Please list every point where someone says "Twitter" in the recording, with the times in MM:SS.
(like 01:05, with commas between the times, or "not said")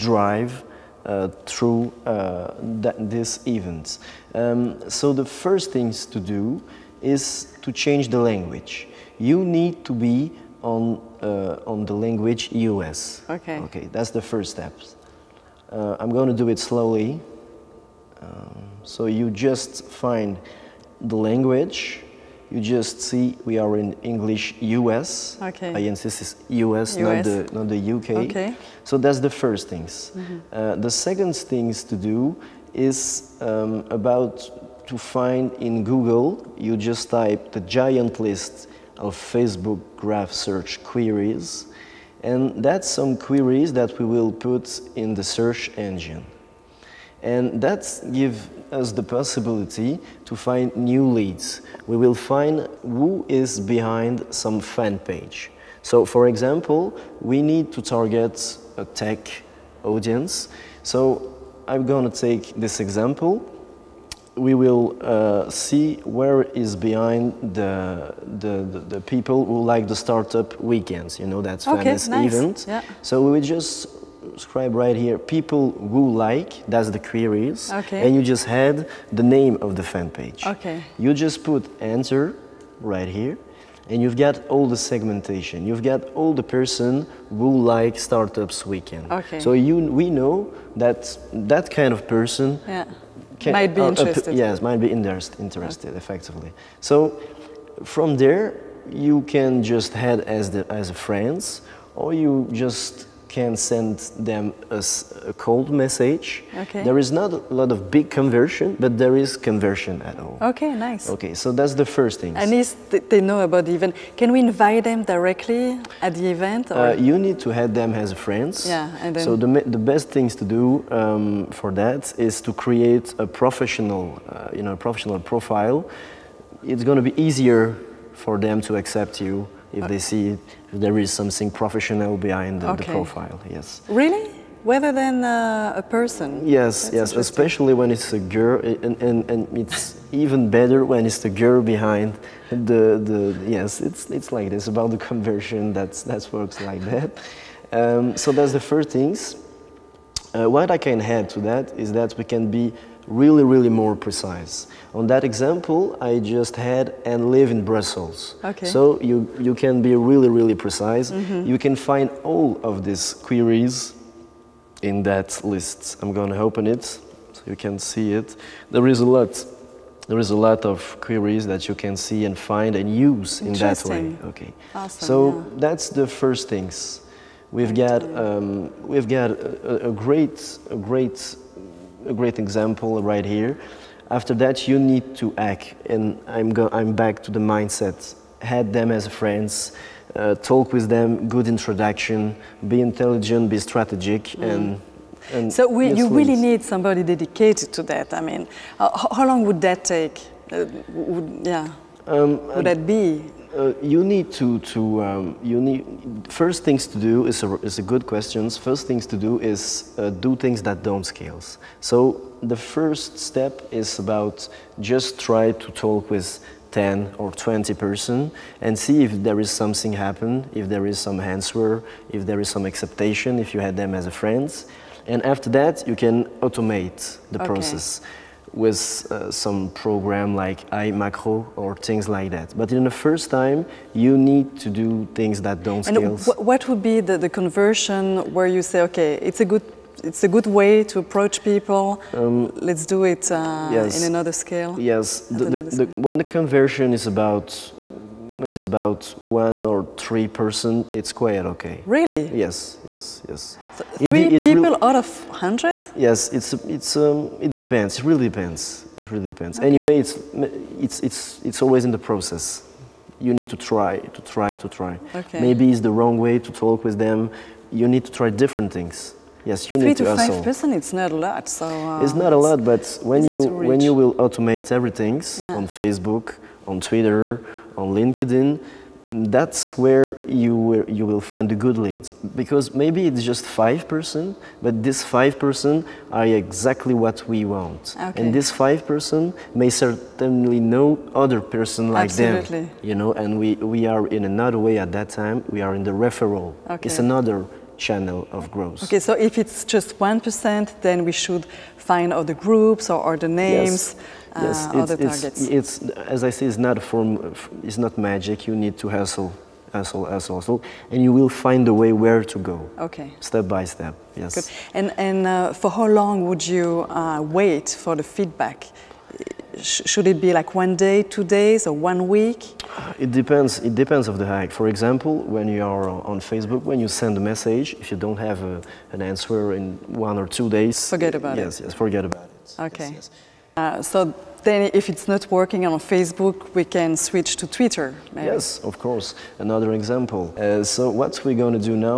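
04:36, 05:37.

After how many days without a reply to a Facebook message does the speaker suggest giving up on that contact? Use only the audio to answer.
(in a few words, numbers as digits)
1 or 2 days.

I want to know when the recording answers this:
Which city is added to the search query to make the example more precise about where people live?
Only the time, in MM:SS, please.
02:37.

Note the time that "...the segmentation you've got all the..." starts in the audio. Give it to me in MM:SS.
01:24.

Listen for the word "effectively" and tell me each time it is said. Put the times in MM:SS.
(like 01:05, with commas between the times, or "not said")
01:35.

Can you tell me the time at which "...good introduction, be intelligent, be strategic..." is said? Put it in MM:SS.
03:11.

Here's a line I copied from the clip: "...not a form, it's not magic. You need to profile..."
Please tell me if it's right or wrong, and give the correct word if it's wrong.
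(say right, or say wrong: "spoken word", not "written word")
wrong: "hustle", not "profile".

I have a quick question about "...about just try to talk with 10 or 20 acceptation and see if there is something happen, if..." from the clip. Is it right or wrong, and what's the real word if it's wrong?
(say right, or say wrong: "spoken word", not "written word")
wrong: "person", not "acceptation".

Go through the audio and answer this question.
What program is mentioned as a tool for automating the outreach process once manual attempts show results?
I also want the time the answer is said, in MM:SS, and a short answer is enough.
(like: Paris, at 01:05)
iMacro, at 03:50.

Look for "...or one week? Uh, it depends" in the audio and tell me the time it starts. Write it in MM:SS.
05:21.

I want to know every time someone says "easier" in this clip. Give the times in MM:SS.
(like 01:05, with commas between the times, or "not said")
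02:07.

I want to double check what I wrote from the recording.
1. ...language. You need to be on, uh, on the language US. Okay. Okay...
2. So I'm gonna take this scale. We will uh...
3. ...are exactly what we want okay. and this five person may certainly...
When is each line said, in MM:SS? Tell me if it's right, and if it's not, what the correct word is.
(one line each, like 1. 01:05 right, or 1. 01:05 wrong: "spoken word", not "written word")
1. 00:08 right
2. 01:00 wrong: "example", not "scale"
3. 04:46 right.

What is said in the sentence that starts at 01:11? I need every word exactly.
You know, that's okay, famous nice.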